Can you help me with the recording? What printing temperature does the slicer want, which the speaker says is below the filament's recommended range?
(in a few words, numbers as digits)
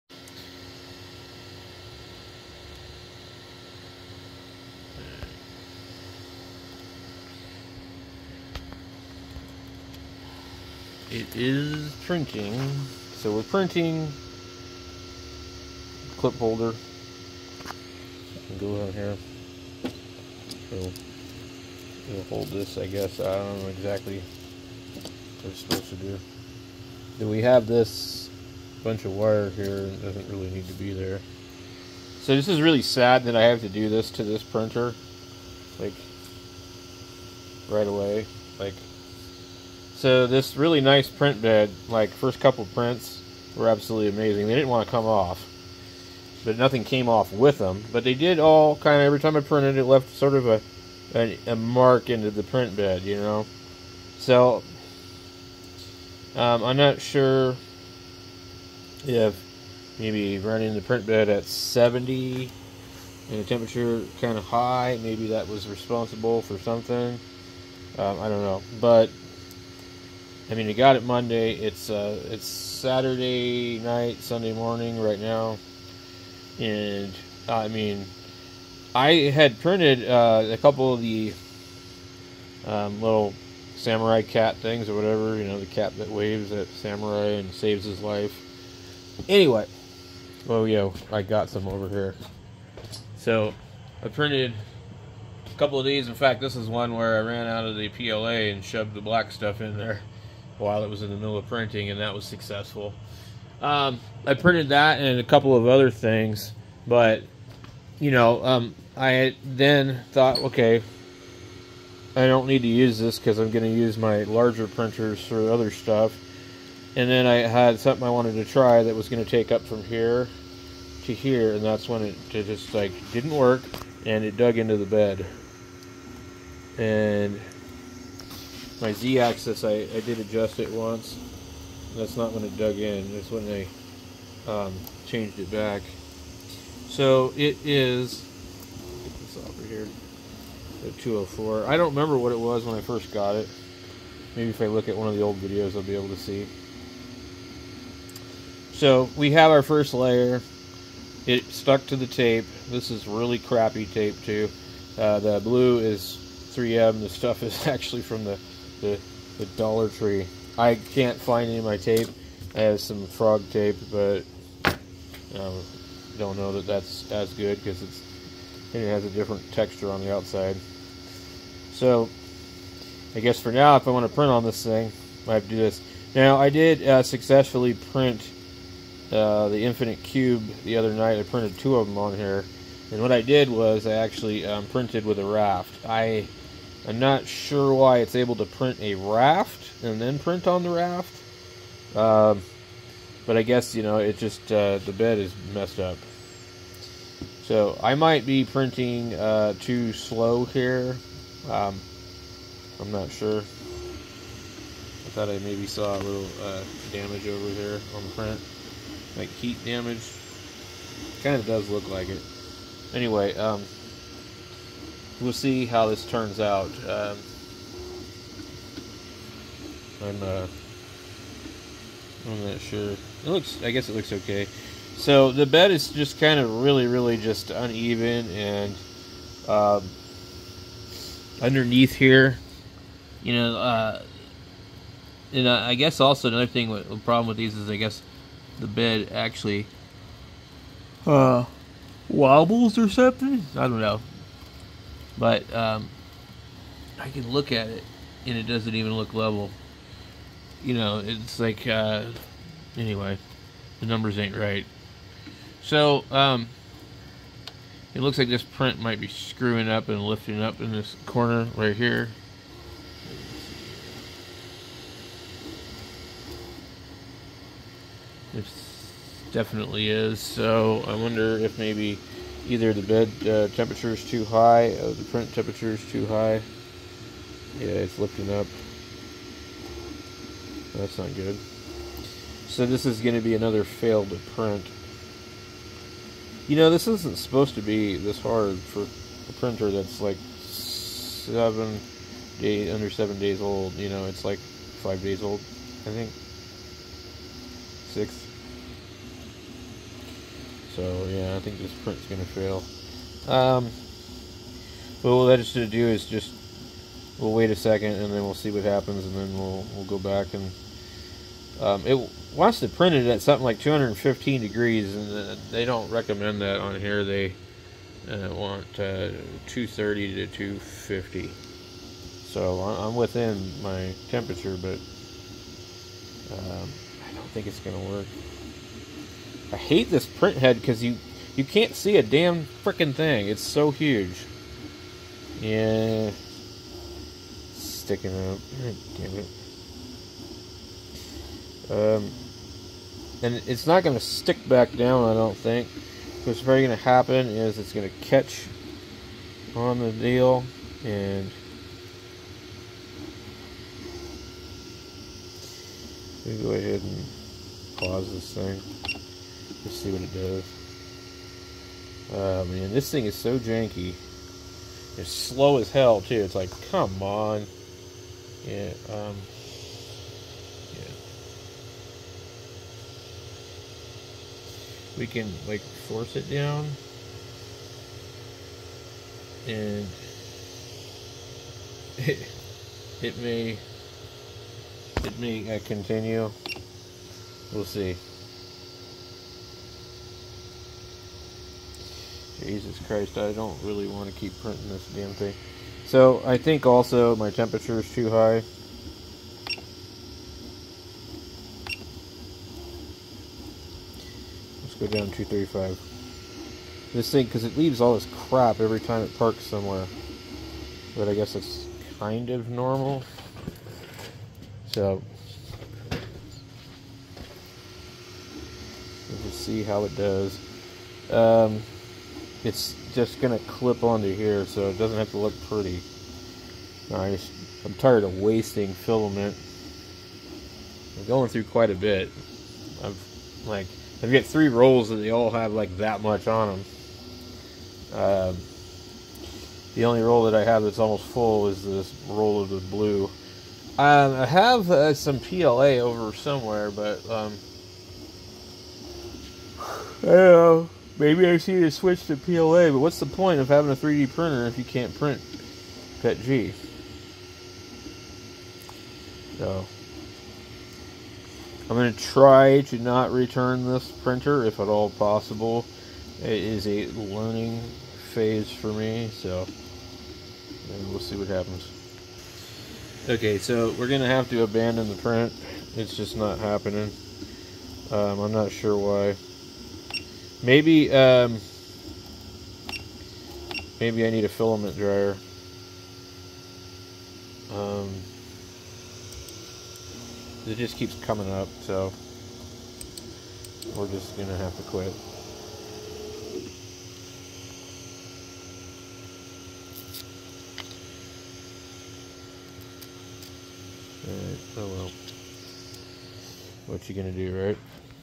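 215.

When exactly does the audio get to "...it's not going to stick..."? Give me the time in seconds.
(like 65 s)
343 s.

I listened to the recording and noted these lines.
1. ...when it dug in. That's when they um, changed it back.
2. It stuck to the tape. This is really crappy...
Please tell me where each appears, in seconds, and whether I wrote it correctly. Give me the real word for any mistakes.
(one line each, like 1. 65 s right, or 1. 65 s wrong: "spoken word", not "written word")
1. 132 s right
2. 151 s right.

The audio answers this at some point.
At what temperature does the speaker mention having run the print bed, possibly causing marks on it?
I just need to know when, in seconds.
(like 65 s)
61 s.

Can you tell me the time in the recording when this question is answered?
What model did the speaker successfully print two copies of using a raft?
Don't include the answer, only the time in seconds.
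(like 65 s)
179 s.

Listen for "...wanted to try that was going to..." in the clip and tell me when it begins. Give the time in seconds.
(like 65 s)
118 s.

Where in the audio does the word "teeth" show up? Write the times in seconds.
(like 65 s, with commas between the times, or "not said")
not said.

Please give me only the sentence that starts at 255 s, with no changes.
So, um, it looks like this print might be screwing up and lifting up in this corner right here.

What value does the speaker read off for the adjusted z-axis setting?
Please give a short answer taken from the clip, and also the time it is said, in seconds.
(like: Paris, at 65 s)
204, at 140 s.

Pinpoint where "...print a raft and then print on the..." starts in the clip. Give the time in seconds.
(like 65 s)
188 s.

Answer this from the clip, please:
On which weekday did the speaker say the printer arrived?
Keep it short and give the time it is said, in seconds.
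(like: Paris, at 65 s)
Monday, at 71 s.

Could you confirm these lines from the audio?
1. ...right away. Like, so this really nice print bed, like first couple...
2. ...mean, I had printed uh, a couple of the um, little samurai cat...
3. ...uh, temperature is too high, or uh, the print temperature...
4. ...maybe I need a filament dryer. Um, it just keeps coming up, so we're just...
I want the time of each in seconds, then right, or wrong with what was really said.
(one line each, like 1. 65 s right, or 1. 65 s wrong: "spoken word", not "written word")
1. 37 s right
2. 77 s right
3. 273 s right
4. 483 s right.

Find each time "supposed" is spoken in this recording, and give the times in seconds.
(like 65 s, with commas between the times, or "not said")
25 s, 287 s.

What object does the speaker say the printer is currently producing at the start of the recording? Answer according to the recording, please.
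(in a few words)
clip holder.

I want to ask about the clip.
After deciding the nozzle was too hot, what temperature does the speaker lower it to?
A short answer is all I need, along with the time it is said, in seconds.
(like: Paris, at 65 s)
235, at 405 s.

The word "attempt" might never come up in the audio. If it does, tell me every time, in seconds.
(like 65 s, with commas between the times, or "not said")
not said.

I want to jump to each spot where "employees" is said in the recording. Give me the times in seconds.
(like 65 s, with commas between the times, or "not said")
not said.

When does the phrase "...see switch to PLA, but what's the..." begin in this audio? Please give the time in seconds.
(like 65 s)
451 s.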